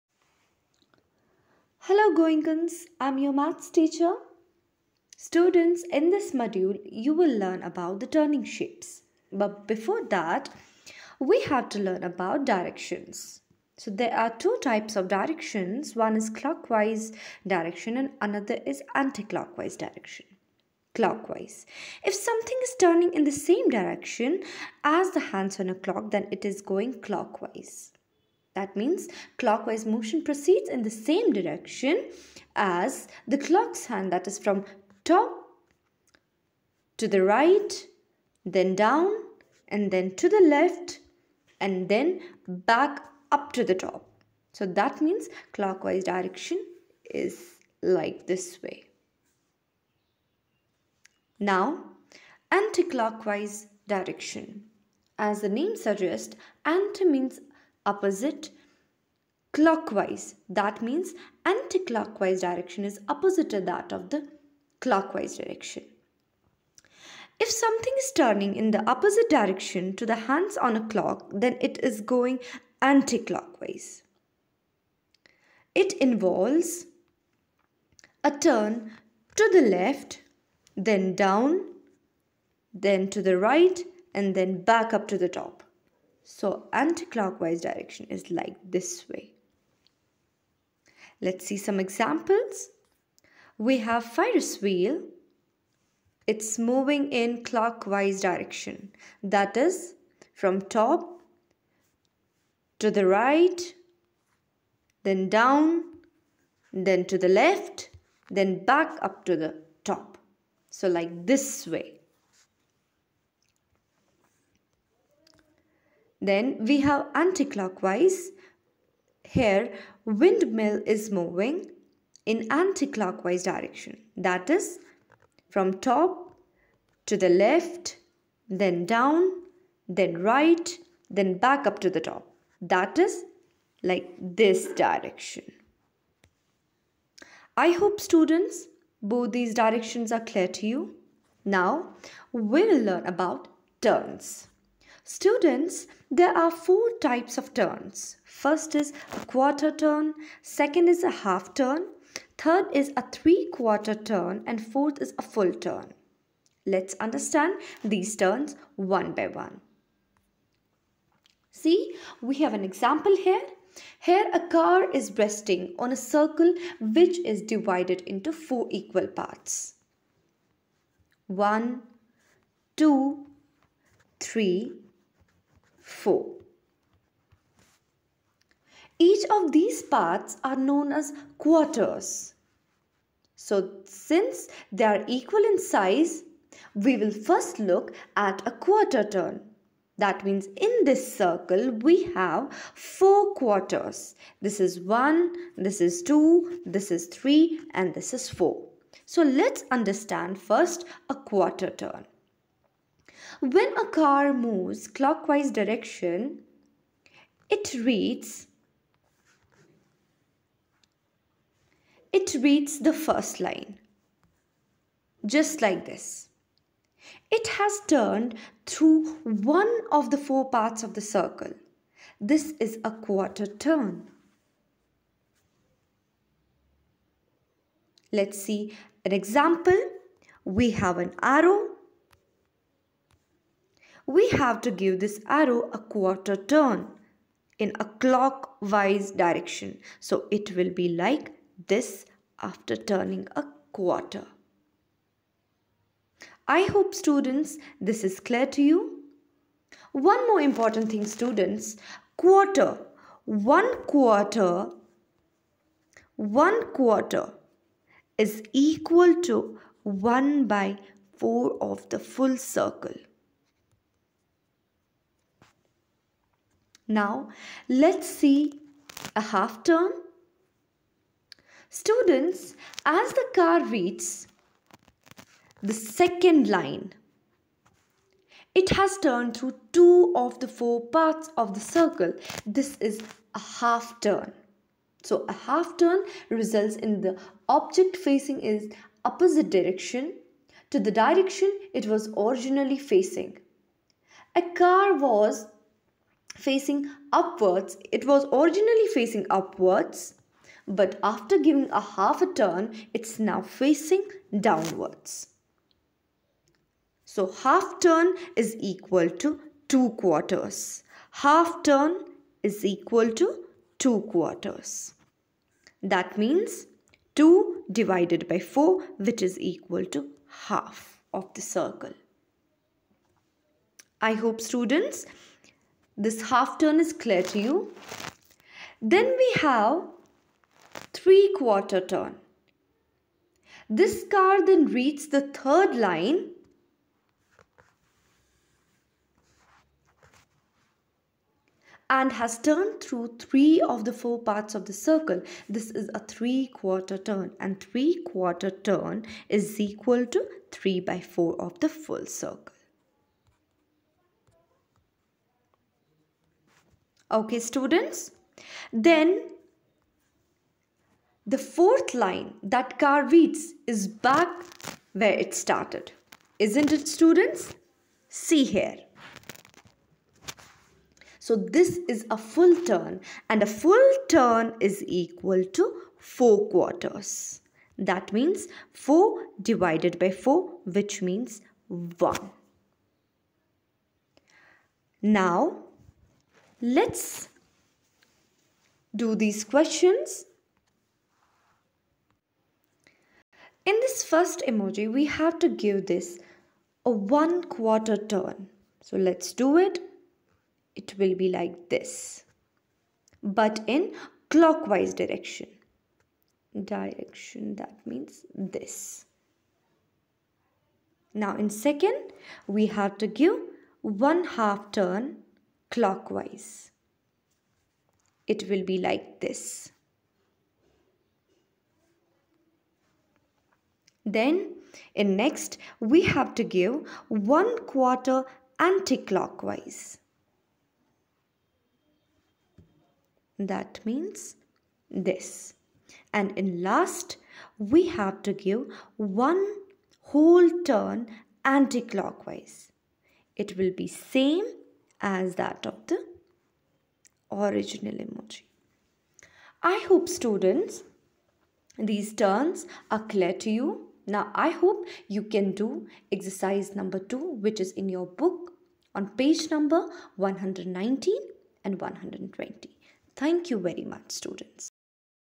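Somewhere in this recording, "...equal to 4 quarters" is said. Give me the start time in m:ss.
6:14.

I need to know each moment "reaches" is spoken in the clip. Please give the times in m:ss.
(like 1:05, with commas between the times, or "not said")
4:33.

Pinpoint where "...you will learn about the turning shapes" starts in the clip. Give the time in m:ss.
0:06.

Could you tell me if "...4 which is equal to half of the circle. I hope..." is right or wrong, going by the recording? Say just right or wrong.
right.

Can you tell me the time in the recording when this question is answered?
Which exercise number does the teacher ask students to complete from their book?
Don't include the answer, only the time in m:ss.
7:36.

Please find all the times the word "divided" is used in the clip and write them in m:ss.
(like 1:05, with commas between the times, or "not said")
2:47, 5:17, 6:19.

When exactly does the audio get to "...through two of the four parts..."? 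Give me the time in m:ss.
4:39.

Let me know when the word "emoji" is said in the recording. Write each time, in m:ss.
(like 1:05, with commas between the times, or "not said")
6:34, 7:27.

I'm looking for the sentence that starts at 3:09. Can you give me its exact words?
That means in this circle we have four quarters.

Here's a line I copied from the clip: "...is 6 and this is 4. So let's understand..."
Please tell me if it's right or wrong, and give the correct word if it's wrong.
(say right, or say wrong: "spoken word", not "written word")
wrong: "3", not "6".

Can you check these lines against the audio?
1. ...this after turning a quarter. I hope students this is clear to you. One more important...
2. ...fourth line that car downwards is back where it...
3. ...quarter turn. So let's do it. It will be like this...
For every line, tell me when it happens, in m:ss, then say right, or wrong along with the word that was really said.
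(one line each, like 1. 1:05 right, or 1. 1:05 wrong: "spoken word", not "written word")
1. 4:01 right
2. 6:01 wrong: "reads", not "downwards"
3. 6:37 right.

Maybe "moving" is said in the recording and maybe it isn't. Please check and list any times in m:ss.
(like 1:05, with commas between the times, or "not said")
1:36, 2:01.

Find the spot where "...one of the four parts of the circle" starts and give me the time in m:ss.
3:39.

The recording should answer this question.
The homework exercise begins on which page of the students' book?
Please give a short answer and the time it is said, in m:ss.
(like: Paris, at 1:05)
119, at 7:39.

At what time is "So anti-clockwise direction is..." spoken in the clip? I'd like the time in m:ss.
1:26.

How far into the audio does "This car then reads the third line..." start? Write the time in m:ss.
5:33.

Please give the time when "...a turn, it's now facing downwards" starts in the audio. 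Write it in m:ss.
5:02.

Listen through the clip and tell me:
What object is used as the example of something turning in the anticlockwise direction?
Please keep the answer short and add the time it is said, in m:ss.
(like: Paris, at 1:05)
Windmill, at 2:00.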